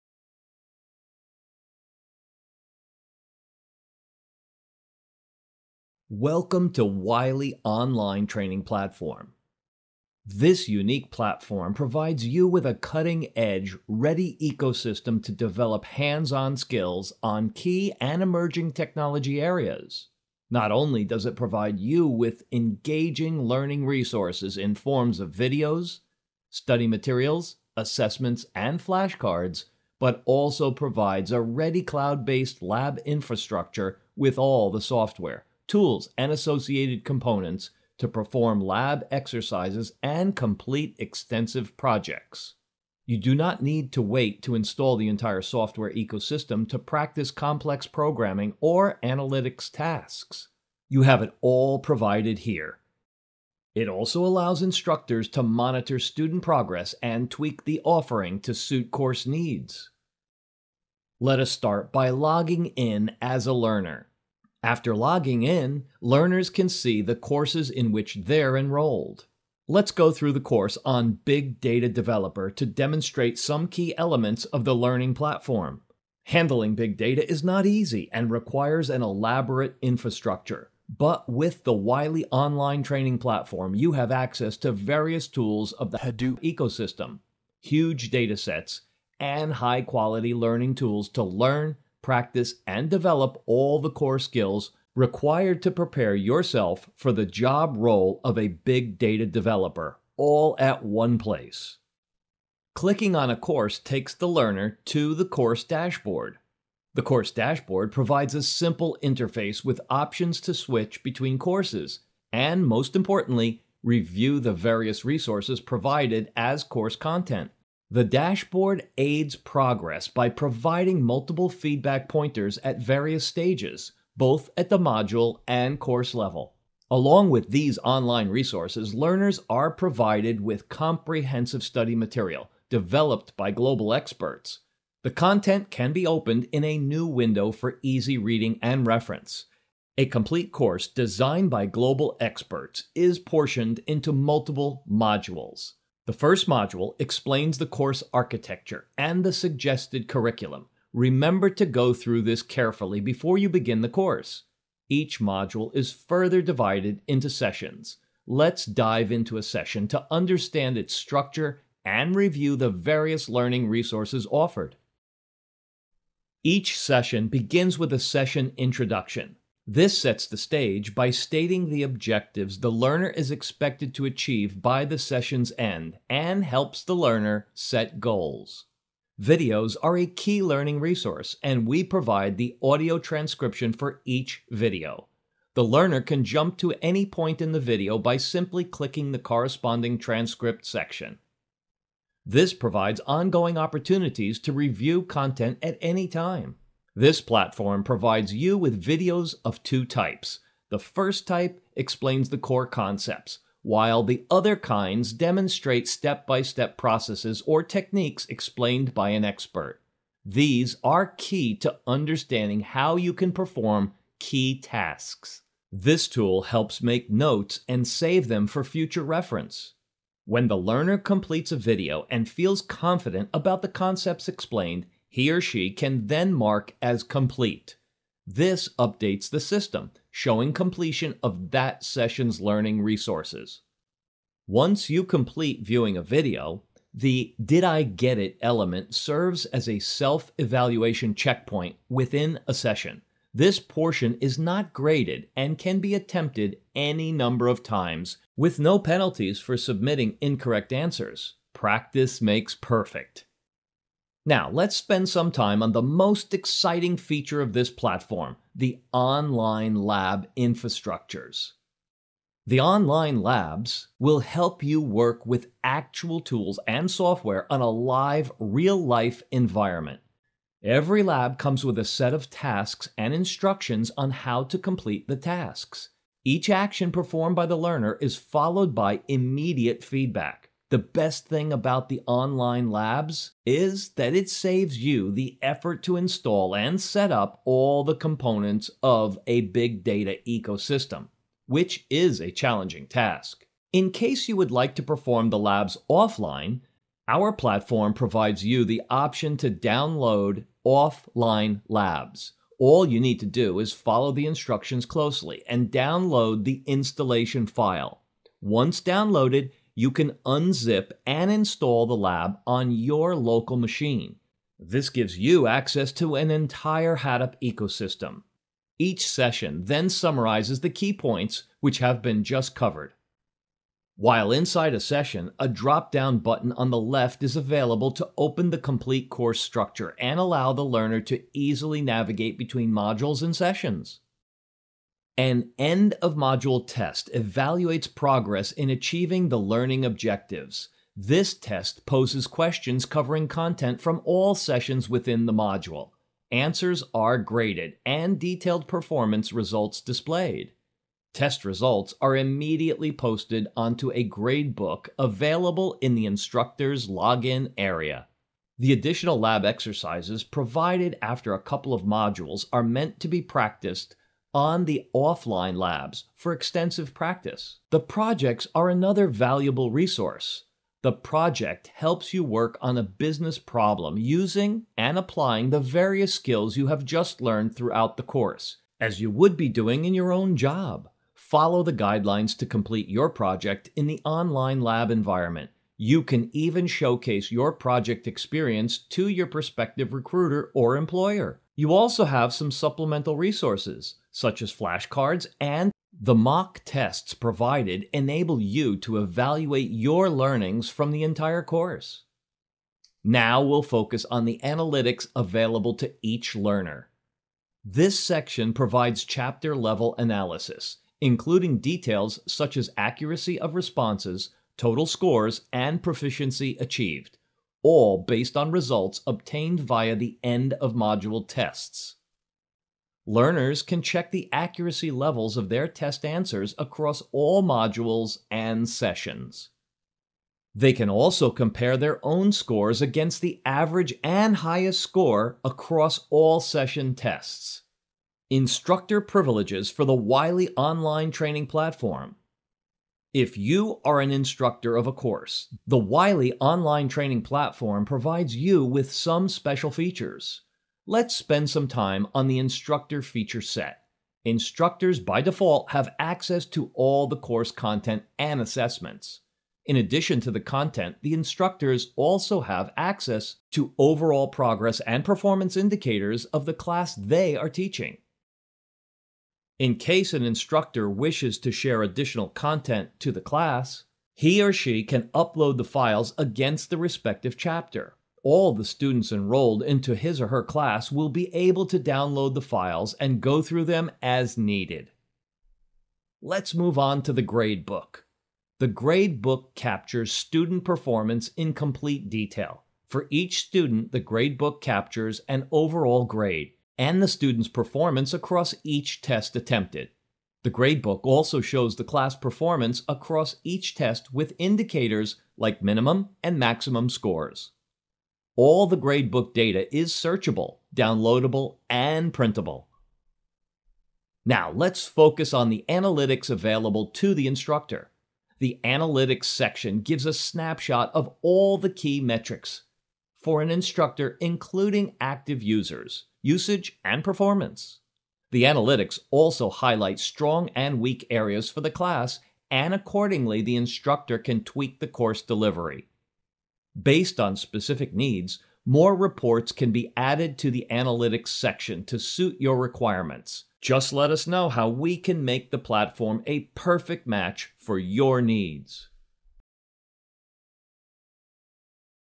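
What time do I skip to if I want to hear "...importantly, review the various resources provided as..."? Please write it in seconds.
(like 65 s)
112 s.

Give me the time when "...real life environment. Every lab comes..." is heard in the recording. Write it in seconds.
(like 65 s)
268 s.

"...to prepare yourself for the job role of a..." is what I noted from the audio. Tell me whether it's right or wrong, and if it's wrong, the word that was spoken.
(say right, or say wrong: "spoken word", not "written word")
right.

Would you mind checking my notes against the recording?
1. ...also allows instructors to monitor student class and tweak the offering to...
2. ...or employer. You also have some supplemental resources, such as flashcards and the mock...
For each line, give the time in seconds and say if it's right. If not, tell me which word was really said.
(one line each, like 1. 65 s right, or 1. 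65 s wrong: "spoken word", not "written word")
1. 53 s wrong: "progress", not "class"
2. 390 s right.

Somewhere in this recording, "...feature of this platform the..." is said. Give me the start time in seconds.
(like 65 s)
256 s.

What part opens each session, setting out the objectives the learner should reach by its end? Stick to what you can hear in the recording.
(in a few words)
Session introduction.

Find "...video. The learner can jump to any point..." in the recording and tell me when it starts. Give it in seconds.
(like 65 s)
184 s.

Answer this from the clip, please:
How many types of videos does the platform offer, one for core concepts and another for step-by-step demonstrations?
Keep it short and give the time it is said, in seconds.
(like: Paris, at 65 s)
2, at 199 s.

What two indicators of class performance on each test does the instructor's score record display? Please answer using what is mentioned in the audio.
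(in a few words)
Minimum and maximum scores.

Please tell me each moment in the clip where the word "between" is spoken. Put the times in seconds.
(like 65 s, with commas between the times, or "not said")
111 s, 332 s.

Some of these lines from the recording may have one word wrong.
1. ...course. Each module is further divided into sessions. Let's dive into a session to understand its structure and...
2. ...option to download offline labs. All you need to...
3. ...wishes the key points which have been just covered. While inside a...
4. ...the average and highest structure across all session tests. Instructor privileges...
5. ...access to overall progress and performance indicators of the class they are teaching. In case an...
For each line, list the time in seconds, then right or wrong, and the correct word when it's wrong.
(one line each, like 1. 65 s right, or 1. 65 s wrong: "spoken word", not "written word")
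1. 153 s right
2. 298 s right
3. 319 s wrong: "summarizes", not "wishes"
4. 433 s wrong: "score", not "structure"
5. 462 s right.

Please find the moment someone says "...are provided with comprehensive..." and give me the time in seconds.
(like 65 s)
129 s.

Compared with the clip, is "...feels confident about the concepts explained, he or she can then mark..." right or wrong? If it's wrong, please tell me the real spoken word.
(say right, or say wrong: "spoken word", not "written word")
right.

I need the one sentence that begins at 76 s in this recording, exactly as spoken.
Handling big data is not easy and requires an elaborate infrastructure.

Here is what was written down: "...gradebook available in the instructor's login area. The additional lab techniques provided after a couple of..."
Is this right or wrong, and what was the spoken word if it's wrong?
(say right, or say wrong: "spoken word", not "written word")
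wrong: "exercises", not "techniques".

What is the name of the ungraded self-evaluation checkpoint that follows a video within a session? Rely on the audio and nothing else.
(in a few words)
Did I Get It.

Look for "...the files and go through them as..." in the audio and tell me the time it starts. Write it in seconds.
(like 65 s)
482 s.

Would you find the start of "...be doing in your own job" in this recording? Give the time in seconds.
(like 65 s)
379 s.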